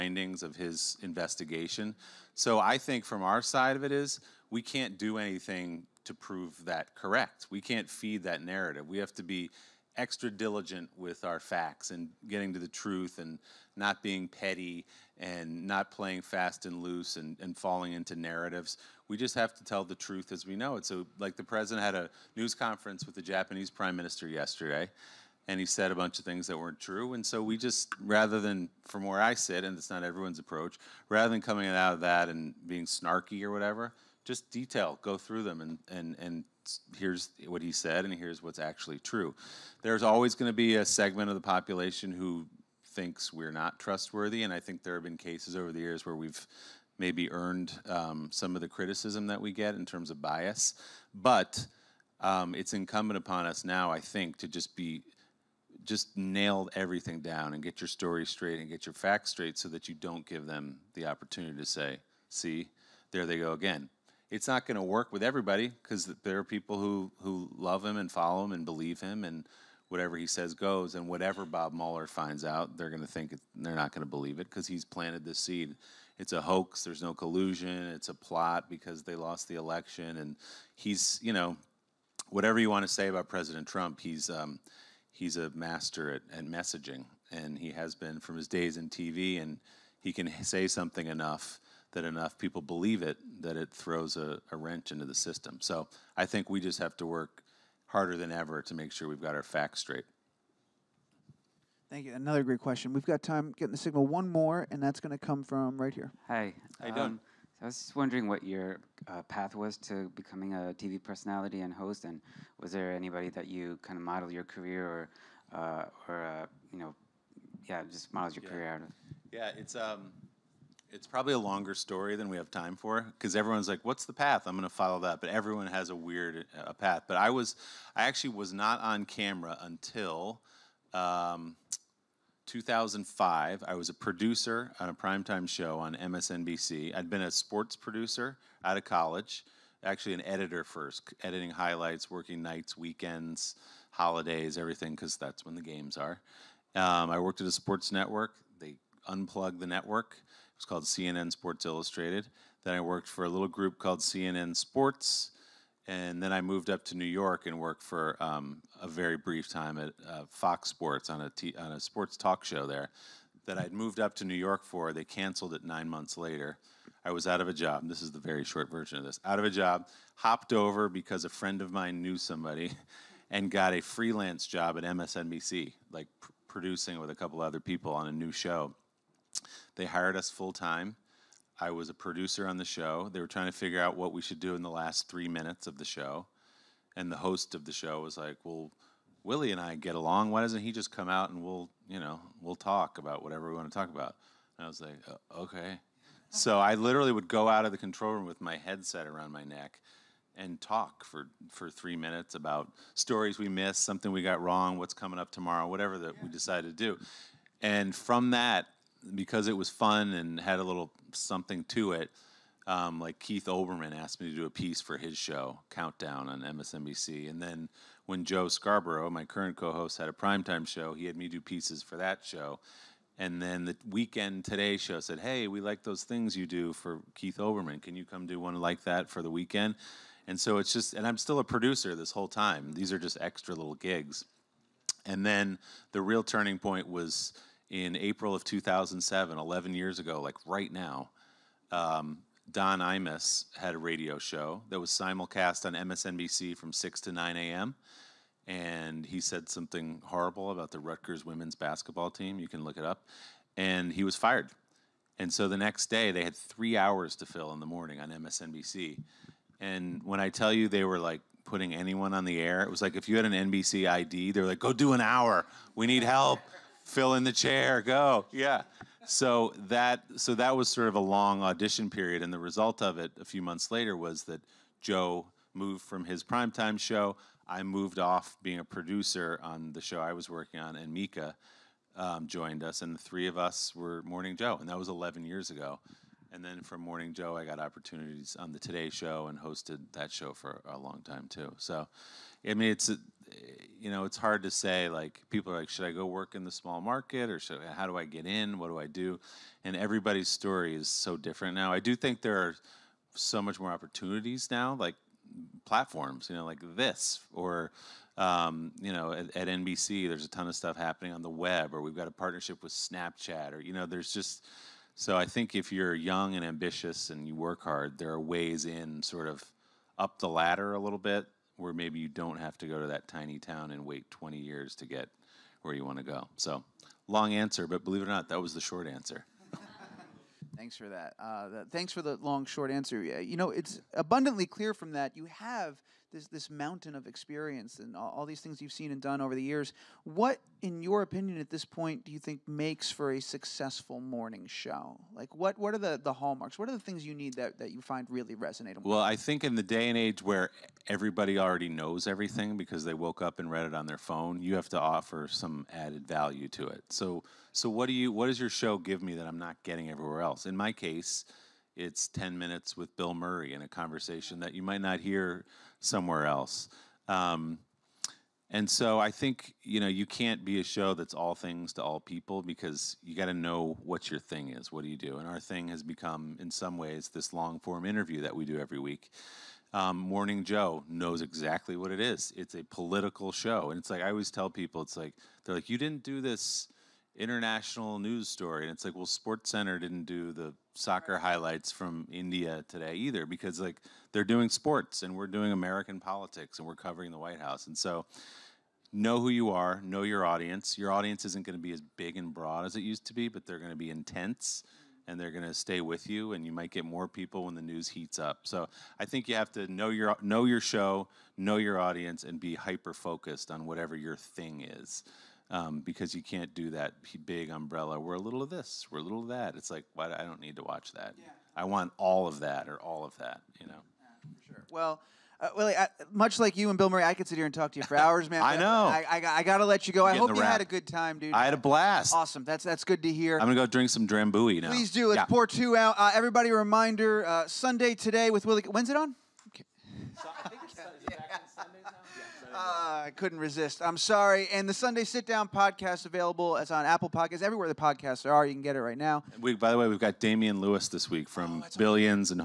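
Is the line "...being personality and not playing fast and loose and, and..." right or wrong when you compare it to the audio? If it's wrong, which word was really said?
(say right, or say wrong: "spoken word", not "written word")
wrong: "petty", not "personality".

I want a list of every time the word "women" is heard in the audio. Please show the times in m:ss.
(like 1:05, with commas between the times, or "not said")
4:11.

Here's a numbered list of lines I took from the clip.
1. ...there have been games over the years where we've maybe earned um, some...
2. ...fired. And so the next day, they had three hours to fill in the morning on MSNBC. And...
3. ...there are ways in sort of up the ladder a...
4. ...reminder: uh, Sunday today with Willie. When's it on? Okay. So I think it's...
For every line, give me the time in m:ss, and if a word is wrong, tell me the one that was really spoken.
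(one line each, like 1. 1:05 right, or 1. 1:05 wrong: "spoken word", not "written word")
1. 0:44 wrong: "cases", not "games"
2. 4:14 right
3. 5:17 right
4. 7:16 right.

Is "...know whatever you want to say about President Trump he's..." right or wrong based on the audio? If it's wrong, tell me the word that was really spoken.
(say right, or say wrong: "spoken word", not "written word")
right.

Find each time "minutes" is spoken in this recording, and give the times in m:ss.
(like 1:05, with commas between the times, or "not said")
3:05, 3:21, 6:02.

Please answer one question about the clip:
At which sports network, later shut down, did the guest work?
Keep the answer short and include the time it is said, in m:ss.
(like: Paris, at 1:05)
CNN Sports Illustrated, at 2:30.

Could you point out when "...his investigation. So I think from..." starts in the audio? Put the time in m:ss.
0:00.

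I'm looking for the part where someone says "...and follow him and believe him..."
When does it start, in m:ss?
1:07.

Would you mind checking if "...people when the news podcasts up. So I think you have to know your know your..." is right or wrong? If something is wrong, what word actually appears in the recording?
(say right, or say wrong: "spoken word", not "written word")
wrong: "heats", not "podcasts".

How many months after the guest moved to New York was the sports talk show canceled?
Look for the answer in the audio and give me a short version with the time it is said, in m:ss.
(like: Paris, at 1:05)
9, at 2:45.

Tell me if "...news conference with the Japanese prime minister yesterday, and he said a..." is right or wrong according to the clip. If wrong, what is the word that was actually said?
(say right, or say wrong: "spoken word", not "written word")
right.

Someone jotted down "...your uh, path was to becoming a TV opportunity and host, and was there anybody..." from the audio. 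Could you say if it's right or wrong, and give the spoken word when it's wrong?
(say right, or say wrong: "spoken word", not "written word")
wrong: "personality", not "opportunity".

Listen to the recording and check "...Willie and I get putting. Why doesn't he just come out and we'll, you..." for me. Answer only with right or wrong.
wrong.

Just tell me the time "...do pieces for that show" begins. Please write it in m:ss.
3:41.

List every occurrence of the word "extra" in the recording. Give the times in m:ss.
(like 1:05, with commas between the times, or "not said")
0:09, 3:53.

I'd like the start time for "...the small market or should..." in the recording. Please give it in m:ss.
4:56.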